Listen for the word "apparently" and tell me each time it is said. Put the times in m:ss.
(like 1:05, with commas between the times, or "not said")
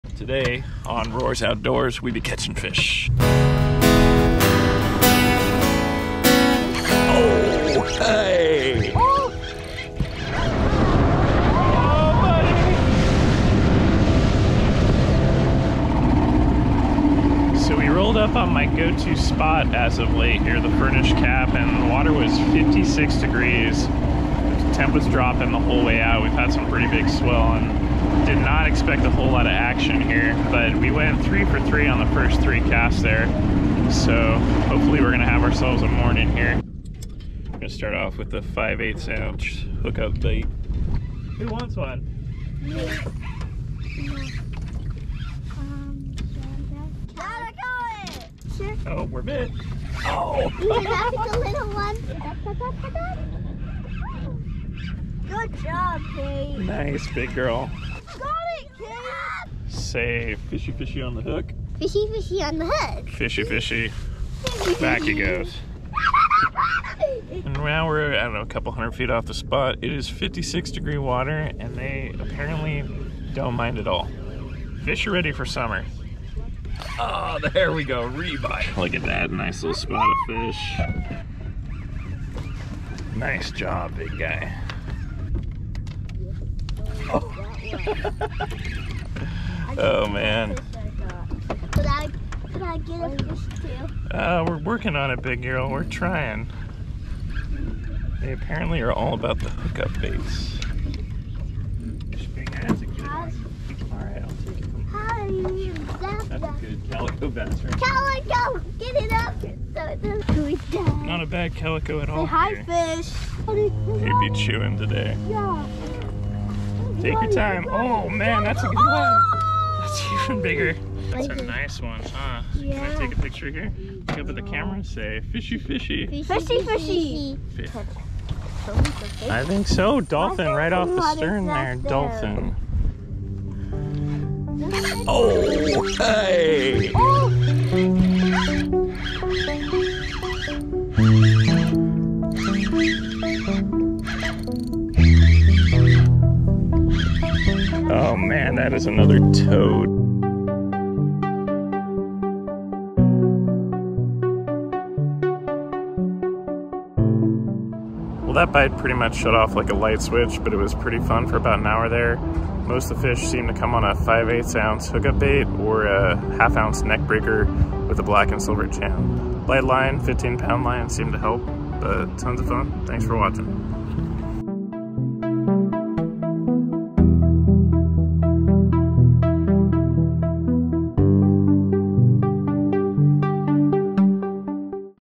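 1:12, 1:38.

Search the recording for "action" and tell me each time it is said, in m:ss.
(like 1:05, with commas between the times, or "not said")
0:29.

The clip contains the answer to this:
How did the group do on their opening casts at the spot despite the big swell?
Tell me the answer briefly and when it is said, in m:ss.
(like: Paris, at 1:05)
three for three, at 0:31.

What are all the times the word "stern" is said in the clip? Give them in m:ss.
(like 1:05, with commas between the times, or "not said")
2:11.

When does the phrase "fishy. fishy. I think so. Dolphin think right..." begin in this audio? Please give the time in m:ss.
2:06.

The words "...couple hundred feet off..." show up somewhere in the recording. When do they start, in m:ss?
1:08.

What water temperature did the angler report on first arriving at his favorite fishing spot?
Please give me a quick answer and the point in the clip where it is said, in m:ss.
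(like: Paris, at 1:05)
56 degrees, at 0:22.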